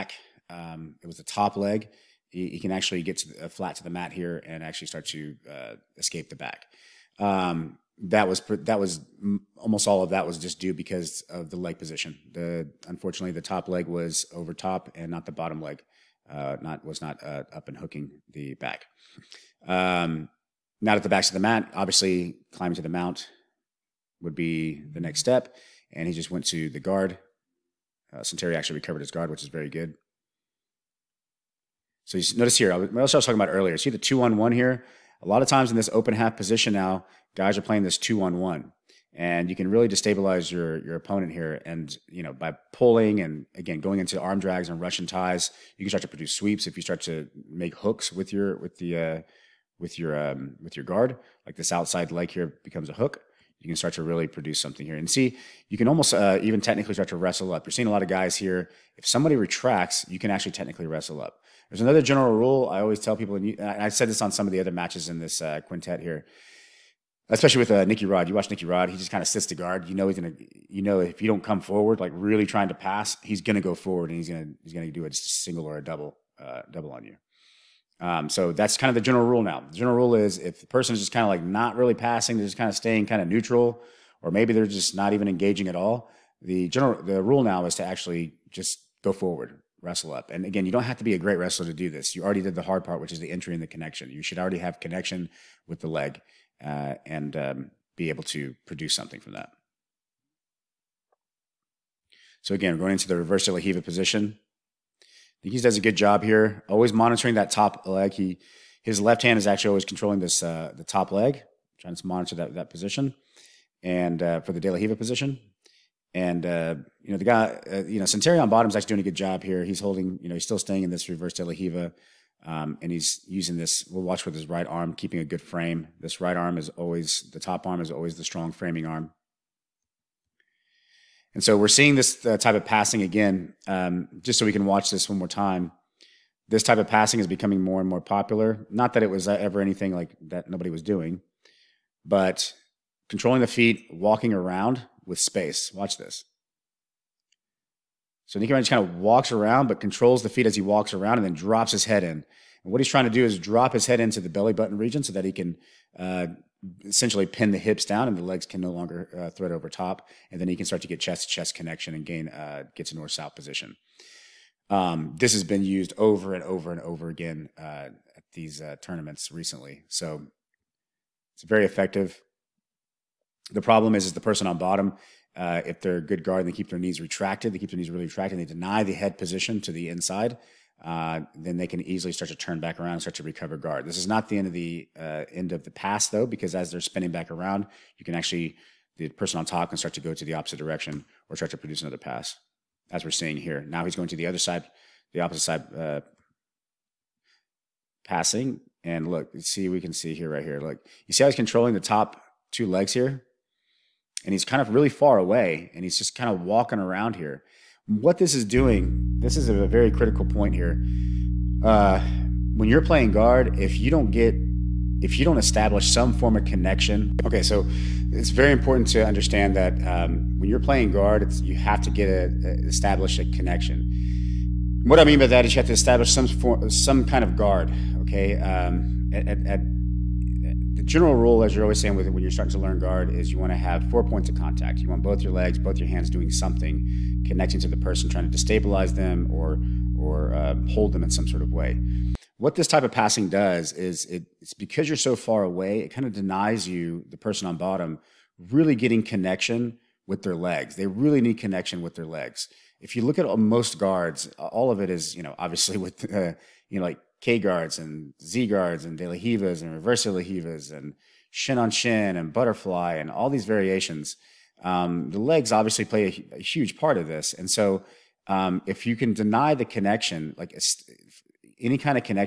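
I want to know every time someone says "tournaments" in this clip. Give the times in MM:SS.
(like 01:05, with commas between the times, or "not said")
02:48.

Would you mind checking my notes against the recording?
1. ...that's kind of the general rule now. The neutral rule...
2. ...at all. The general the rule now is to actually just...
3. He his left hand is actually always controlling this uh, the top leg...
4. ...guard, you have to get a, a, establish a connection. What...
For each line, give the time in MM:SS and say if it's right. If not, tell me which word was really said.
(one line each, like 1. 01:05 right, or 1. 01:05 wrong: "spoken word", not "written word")
1. 01:18 wrong: "general", not "neutral"
2. 01:25 right
3. 01:48 right
4. 03:40 right.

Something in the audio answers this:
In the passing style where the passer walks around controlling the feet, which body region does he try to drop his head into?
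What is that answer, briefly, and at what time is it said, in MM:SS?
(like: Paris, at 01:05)
Belly button region, at 02:34.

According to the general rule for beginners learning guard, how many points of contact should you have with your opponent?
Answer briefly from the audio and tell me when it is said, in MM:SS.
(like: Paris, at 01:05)
4, at 03:53.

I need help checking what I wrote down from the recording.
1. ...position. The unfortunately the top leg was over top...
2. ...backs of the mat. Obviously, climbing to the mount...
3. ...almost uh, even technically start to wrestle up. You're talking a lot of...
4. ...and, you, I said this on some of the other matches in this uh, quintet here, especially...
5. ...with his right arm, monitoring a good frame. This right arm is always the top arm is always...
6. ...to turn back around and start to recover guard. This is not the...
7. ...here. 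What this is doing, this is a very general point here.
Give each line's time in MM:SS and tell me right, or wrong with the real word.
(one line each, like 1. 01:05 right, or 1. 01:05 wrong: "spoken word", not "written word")
1. 00:11 right
2. 00:21 right
3. 00:55 wrong: "seeing", not "talking"
4. 01:03 right
5. 02:04 wrong: "keeping", not "monitoring"
6. 03:02 right
7. 03:27 wrong: "critical", not "general".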